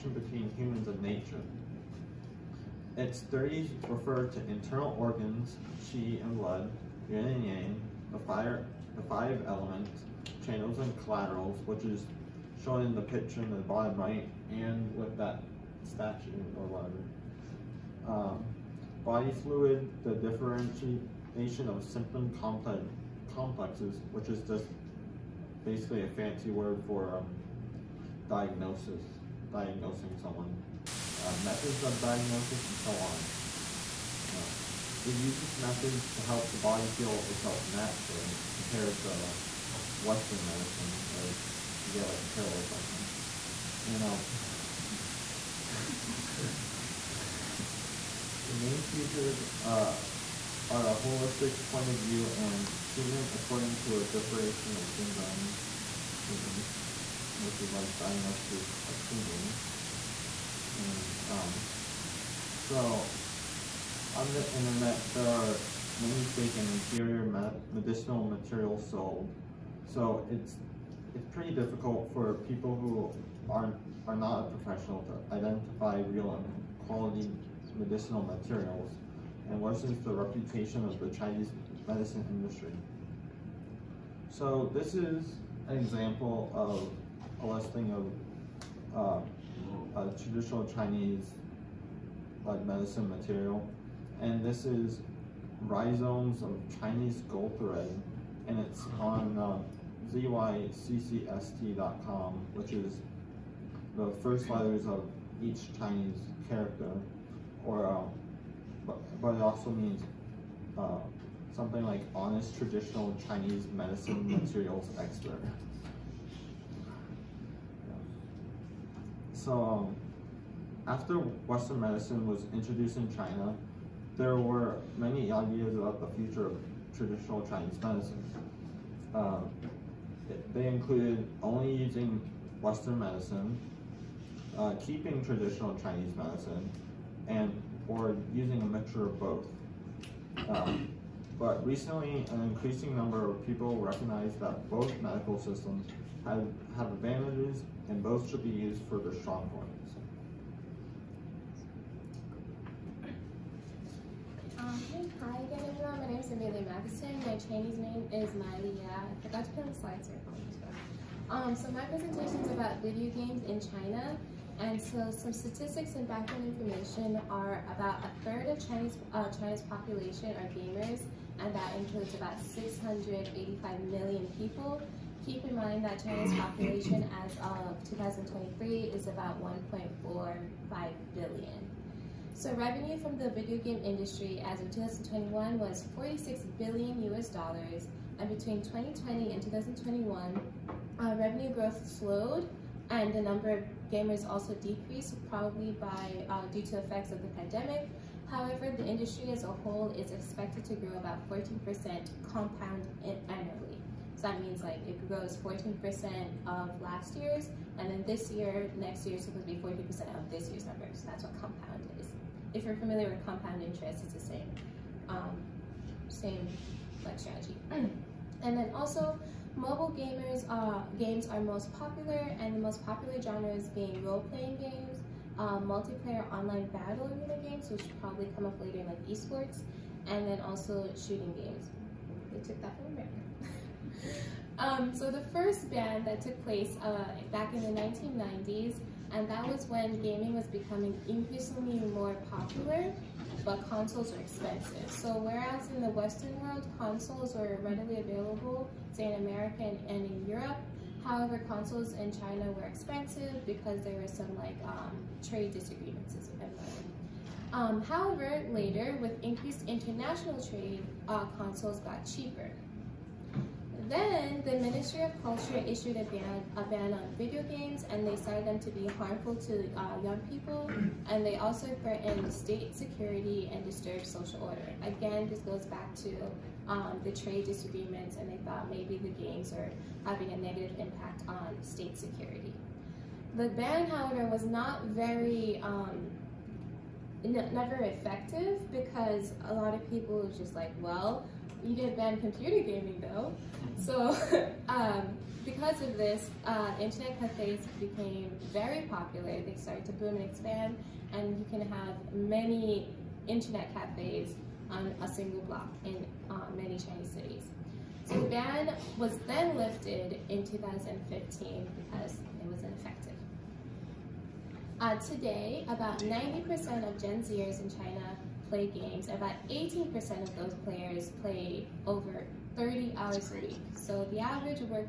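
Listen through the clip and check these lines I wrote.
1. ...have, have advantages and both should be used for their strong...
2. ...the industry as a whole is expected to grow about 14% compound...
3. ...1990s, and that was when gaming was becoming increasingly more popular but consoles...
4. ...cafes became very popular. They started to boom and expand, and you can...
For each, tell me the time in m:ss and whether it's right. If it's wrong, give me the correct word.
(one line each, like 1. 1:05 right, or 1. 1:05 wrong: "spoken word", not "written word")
1. 2:26 right
2. 3:18 right
3. 3:57 right
4. 4:57 right.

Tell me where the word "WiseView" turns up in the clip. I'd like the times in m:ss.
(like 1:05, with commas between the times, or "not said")
not said.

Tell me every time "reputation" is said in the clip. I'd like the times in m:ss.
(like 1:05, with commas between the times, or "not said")
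1:20.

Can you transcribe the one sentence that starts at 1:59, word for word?
So um, after Western medicine was introduced in China, there were many ideas about the future of traditional Chinese medicine.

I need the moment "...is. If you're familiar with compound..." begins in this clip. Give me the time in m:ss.
3:31.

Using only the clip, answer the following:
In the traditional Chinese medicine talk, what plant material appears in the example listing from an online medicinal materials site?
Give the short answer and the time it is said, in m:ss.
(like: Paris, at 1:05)
Rhizomes of Chinese gold thread, at 1:35.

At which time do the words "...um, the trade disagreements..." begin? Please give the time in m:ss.
4:36.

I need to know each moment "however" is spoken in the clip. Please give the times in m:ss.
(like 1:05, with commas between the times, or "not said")
3:18, 4:11, 4:17, 4:43.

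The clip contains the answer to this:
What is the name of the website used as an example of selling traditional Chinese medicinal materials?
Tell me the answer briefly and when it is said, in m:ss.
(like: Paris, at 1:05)
zyccst.com, at 1:40.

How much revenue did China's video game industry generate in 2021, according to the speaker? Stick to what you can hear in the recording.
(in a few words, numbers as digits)
46 billion US dollars.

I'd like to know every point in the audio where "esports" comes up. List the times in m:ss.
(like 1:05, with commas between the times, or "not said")
3:49.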